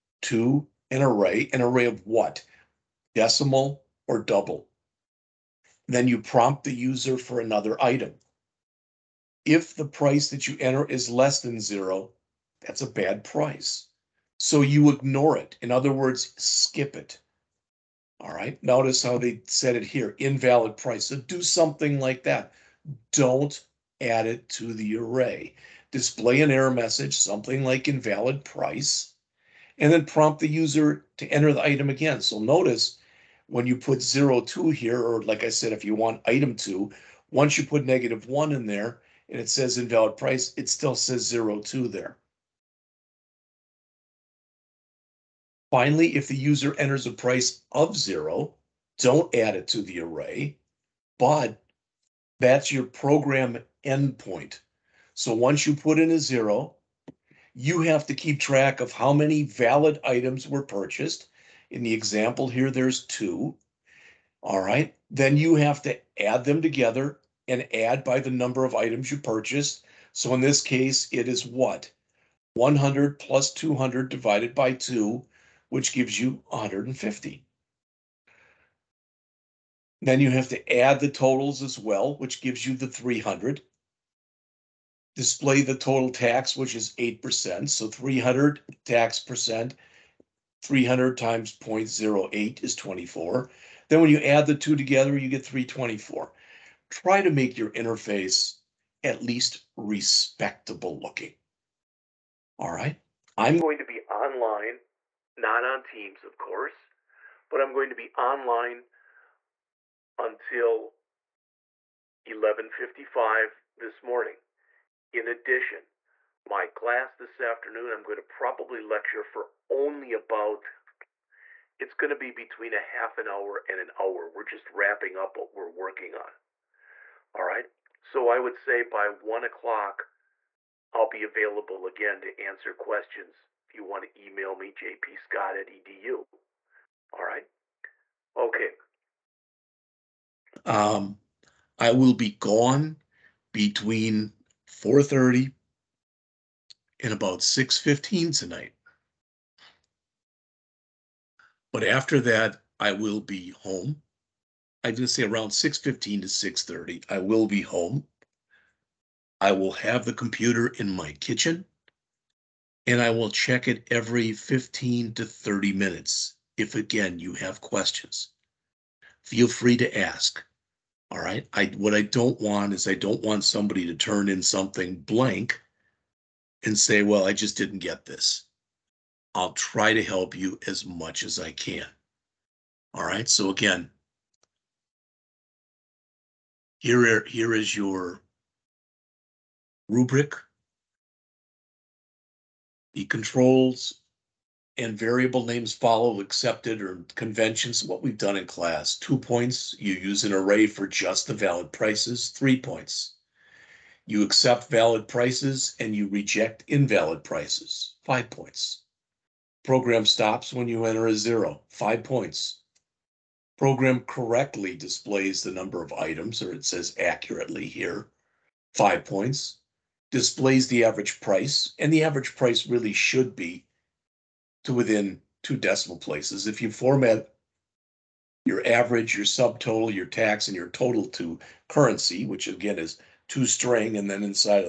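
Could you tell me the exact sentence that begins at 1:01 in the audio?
In the example here, there's two.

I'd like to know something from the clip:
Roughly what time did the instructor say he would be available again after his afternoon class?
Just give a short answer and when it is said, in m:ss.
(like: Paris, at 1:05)
one o'clock, at 2:09.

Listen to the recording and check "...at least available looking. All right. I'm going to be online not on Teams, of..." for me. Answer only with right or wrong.
wrong.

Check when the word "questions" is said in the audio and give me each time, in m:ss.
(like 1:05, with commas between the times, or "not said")
2:12, 2:47.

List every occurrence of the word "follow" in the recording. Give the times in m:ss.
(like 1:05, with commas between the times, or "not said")
3:15.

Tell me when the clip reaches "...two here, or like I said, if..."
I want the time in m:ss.
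0:34.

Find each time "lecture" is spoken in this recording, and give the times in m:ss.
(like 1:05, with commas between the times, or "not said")
1:58.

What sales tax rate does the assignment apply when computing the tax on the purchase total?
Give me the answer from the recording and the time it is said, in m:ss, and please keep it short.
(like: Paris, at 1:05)
8%, at 1:26.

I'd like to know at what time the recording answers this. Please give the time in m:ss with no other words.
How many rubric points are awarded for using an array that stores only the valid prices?
3:22.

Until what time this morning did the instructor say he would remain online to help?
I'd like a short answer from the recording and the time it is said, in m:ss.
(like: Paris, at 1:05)
11:55, at 1:52.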